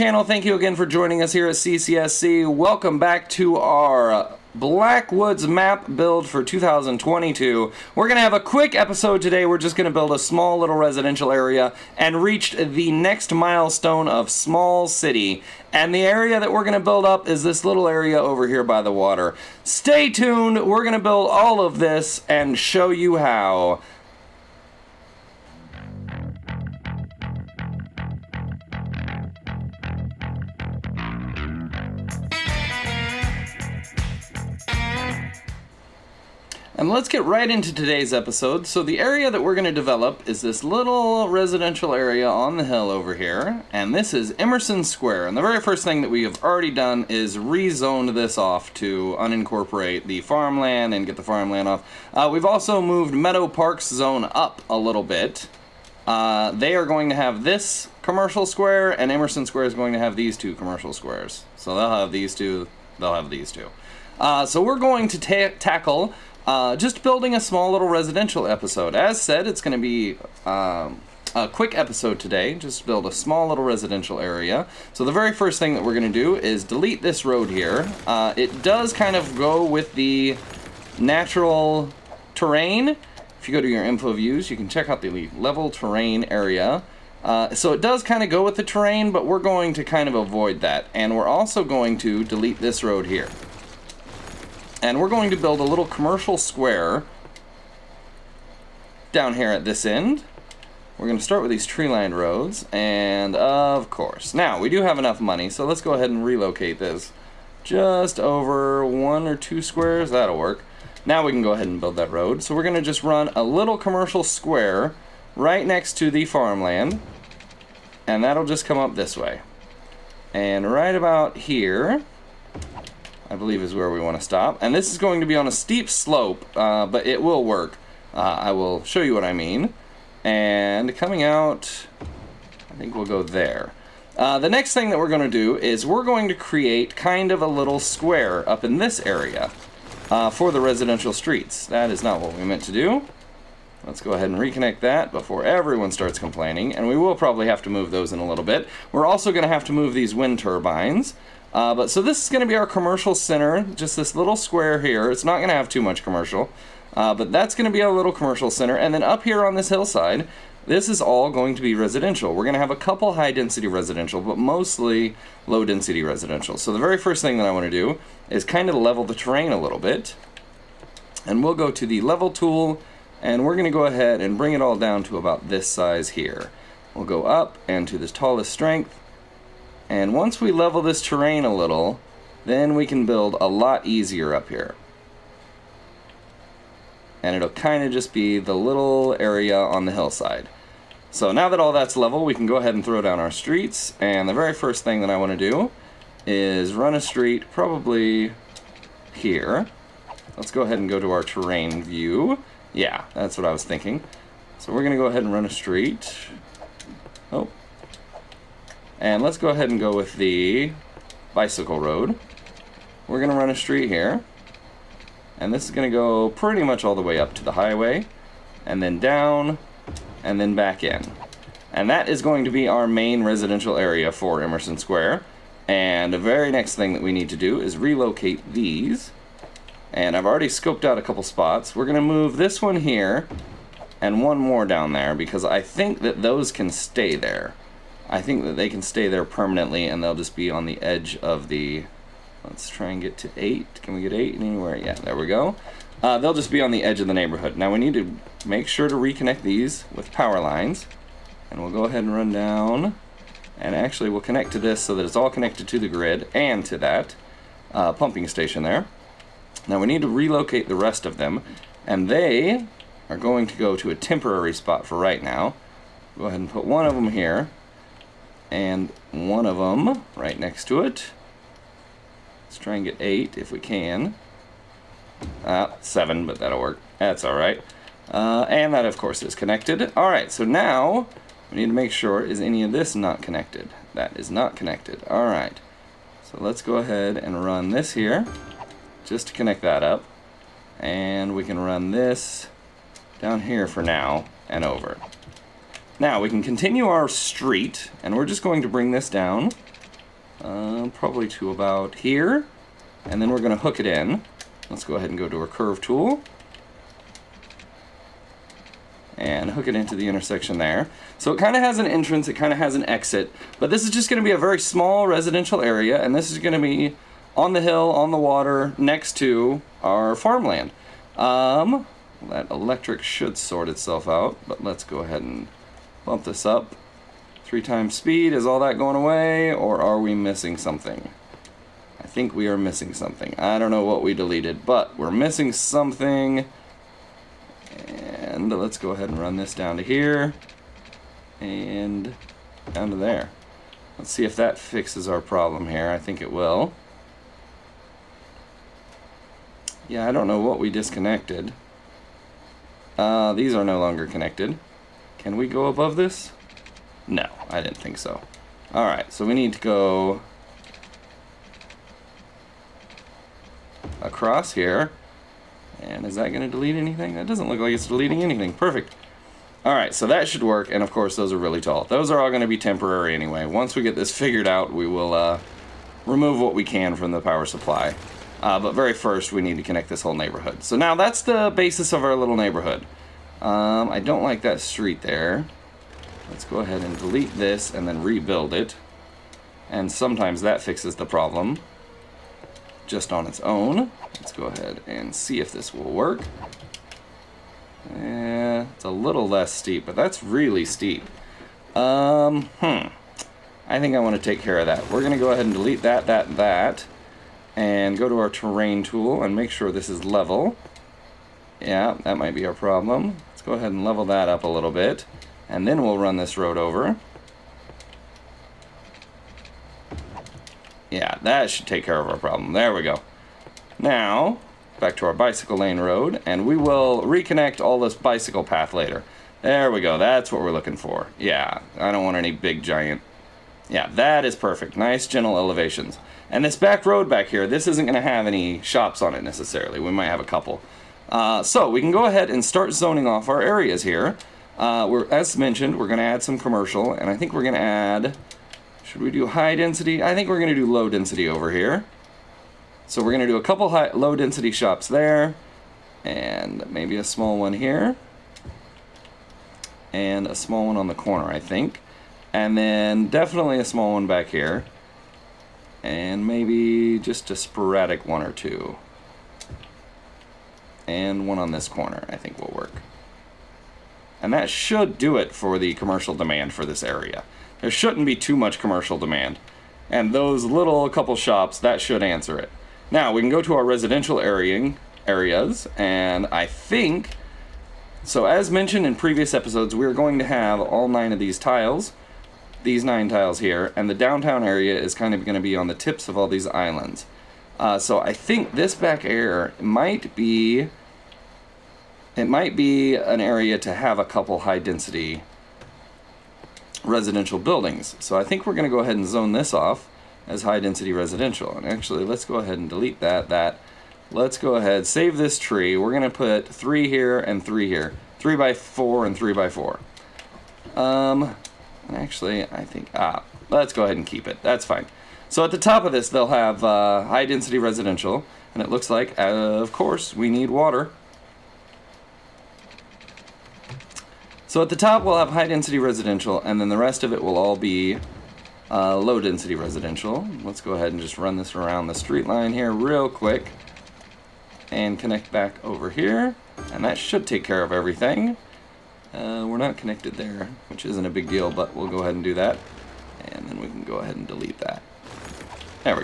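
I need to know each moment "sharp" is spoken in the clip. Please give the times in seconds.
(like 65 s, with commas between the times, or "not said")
not said.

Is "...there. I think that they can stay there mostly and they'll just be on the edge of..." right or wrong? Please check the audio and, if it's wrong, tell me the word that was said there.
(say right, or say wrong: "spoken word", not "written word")
wrong: "permanently", not "mostly".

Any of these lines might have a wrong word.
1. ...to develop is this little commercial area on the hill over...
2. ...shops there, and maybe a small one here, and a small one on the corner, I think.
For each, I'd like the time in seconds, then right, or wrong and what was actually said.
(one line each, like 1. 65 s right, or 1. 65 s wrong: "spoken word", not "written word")
1. 39 s wrong: "residential", not "commercial"
2. 454 s right.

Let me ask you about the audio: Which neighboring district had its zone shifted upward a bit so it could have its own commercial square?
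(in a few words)
Meadow Park.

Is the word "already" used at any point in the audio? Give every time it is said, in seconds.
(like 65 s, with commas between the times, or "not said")
46 s, 230 s.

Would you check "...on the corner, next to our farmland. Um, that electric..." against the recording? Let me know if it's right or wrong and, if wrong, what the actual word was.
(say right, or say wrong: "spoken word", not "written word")
wrong: "water", not "corner".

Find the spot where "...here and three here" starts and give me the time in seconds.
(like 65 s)
516 s.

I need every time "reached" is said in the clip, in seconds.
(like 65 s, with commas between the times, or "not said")
12 s.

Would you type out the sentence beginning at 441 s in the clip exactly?
Uh, so we can go ahead and start zoning off our areas here.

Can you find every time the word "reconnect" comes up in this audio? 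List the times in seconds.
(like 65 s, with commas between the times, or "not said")
144 s, 248 s, 427 s.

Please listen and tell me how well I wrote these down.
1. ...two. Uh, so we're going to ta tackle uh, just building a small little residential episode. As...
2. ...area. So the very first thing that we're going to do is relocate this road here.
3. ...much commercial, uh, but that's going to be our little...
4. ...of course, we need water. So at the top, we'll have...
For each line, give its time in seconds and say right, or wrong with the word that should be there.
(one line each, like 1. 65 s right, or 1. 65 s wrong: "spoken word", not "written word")
1. 63 s right
2. 74 s wrong: "delete", not "relocate"
3. 155 s right
4. 529 s right.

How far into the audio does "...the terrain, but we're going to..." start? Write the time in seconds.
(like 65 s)
88 s.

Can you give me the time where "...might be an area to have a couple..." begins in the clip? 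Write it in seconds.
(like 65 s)
502 s.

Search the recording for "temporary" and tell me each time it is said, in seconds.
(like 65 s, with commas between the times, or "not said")
263 s, 372 s.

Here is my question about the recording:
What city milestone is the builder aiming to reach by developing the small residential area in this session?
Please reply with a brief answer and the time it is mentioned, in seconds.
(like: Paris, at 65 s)
small city, at 14 s.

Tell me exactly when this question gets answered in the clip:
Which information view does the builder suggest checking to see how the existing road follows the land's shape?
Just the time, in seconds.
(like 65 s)
85 s.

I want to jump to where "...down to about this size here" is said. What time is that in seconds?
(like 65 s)
174 s.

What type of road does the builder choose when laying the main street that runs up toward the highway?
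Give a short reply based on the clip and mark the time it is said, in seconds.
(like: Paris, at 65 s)
bicycle road, at 211 s.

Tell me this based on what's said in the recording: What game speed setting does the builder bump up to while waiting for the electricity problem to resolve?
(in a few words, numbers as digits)
3 times speed.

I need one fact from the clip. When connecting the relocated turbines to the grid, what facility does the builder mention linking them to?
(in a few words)
pumping station.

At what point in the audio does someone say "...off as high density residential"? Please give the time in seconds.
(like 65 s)
509 s.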